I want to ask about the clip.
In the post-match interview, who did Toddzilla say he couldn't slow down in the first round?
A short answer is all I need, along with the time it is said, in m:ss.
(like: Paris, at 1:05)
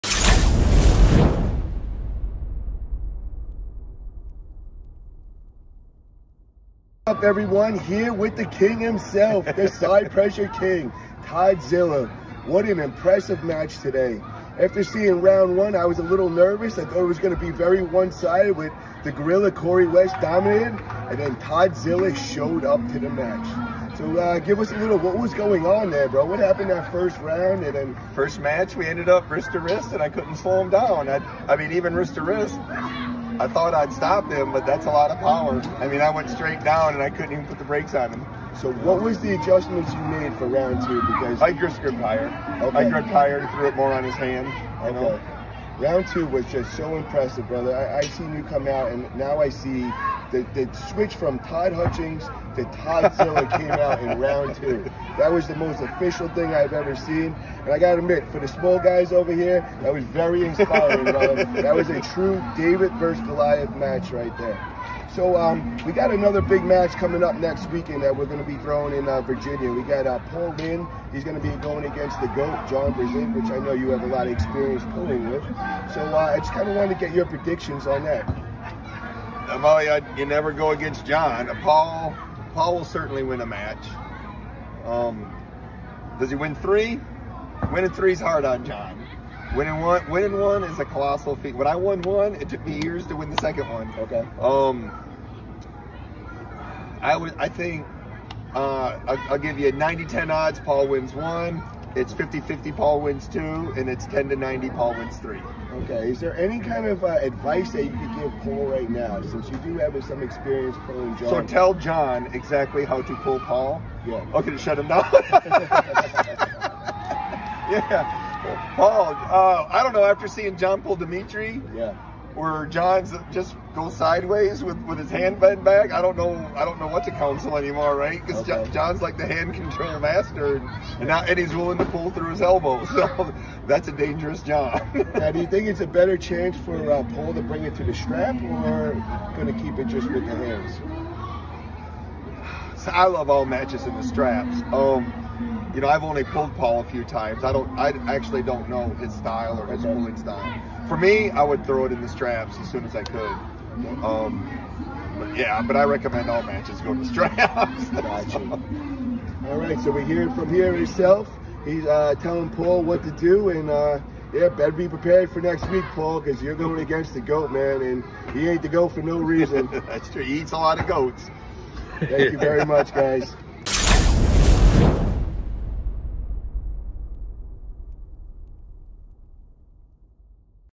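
Corey West, at 0:19.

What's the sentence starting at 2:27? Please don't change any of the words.
I don't, I actually don't know his style or his pulling style.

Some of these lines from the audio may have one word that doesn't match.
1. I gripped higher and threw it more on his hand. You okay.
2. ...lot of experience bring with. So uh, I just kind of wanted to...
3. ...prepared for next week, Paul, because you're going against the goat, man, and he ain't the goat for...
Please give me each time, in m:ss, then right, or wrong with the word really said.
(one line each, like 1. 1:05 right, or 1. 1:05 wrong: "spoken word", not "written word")
1. 0:42 right
2. 1:14 wrong: "pulling", not "bring"
3. 2:44 right.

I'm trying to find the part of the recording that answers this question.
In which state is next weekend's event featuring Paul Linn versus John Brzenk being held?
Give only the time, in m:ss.
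1:09.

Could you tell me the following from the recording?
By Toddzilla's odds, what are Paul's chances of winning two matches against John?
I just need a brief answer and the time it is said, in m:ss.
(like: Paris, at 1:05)
50-50, at 1:42.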